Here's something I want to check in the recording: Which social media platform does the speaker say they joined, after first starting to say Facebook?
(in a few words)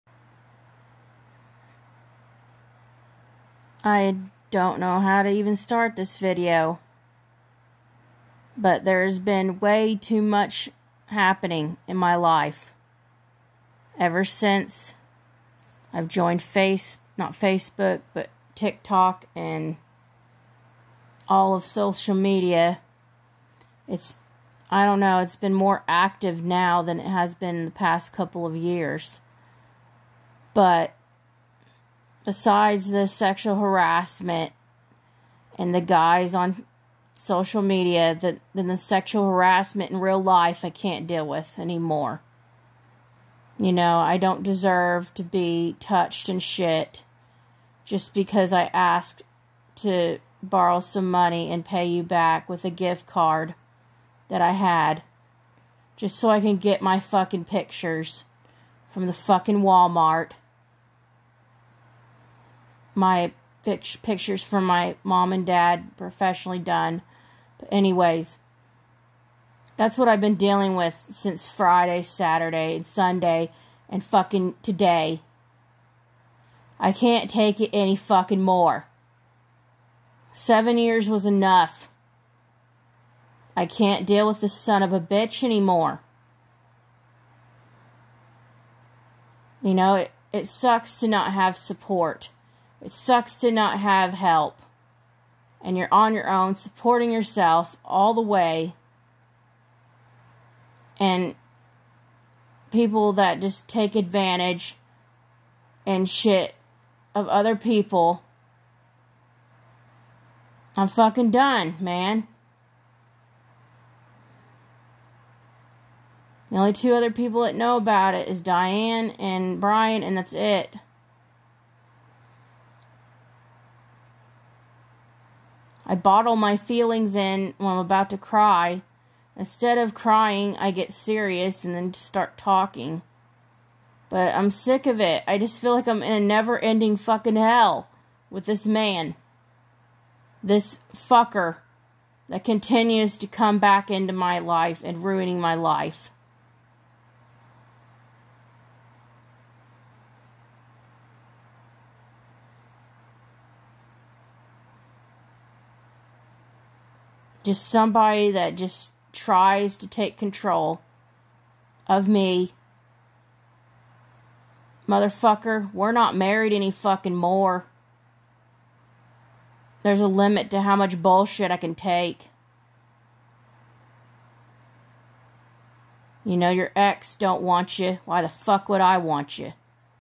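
TikTok.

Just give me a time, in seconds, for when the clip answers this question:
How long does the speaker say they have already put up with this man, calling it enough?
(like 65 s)
80 s.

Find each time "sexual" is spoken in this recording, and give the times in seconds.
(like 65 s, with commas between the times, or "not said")
33 s, 38 s.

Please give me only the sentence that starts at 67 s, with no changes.
But anyways, that's what I've been dealing with since Friday, Saturday, and Sunday, and fucking today.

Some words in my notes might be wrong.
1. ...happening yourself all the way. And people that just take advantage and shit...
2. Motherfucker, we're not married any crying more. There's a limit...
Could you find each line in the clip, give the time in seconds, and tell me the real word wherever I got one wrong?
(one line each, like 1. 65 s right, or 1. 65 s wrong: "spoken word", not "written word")
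1. 96 s wrong: "supporting", not "happening"
2. 164 s wrong: "fucking", not "crying".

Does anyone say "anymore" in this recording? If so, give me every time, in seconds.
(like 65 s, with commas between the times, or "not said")
41 s, 85 s.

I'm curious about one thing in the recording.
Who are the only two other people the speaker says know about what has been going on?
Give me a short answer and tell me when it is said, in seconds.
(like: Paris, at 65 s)
Diane and Brian, at 118 s.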